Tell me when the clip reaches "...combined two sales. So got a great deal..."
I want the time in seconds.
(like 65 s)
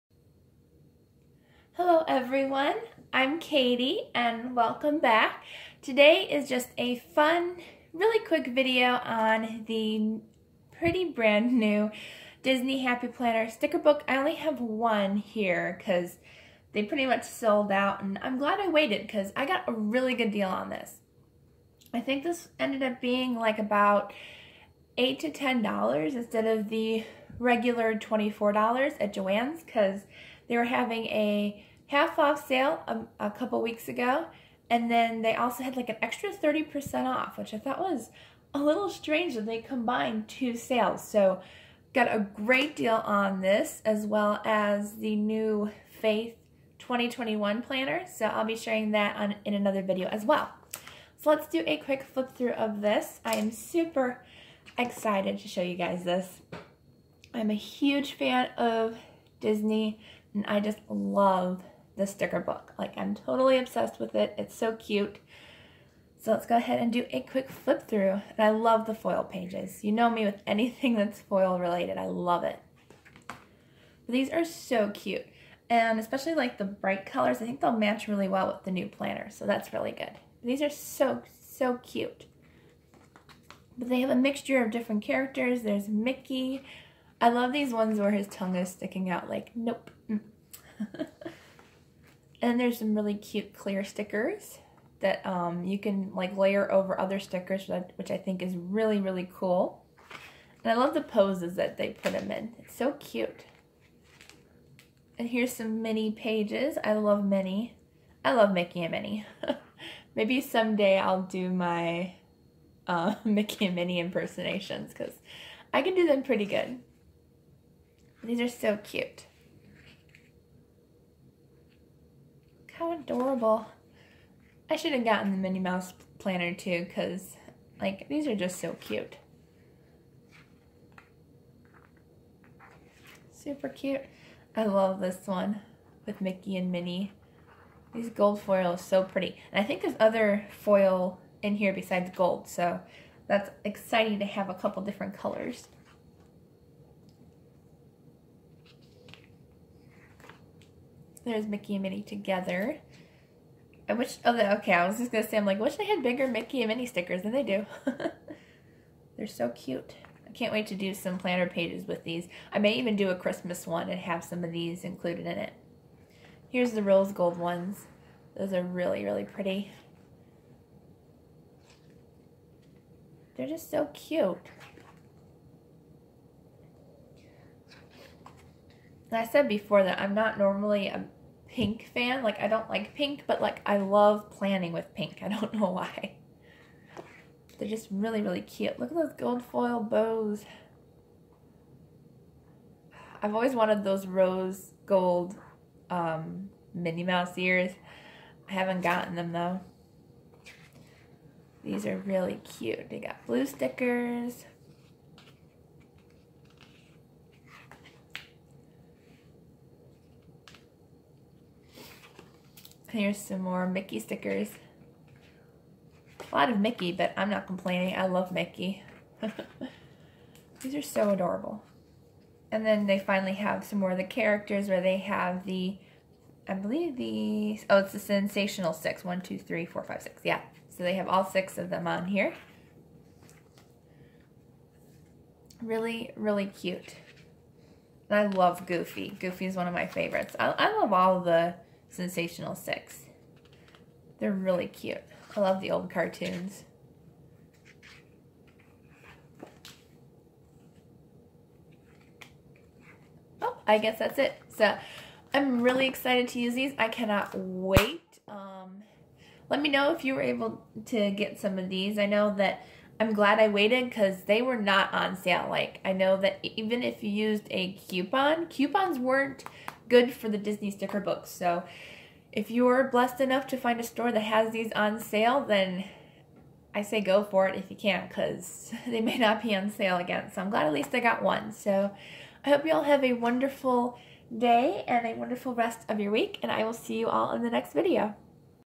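39 s.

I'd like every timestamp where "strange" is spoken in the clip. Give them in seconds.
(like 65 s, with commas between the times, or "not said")
38 s.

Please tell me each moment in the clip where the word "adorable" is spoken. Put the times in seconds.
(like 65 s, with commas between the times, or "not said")
122 s, 221 s.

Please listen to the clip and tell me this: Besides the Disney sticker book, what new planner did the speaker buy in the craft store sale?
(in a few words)
Faith 2021 planner.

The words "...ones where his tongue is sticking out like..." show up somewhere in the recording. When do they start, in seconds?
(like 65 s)
87 s.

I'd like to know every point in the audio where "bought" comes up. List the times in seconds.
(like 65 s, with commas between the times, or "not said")
not said.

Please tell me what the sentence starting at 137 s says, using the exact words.
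These gold foil is so pretty.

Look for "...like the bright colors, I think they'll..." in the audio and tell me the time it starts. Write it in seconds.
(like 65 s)
76 s.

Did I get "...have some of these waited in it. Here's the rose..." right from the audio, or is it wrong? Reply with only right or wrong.
wrong.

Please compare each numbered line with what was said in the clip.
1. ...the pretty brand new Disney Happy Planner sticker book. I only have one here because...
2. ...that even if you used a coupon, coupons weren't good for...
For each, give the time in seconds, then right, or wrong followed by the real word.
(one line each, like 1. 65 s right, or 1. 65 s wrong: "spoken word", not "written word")
1. 9 s right
2. 266 s right.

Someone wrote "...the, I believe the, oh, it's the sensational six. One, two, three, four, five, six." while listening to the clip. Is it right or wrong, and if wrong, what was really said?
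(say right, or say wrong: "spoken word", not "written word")
right.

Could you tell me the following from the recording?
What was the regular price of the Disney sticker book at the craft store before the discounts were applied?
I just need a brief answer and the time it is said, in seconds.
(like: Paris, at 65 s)
$24, at 27 s.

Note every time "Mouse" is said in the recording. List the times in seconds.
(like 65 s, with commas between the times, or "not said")
125 s, 197 s.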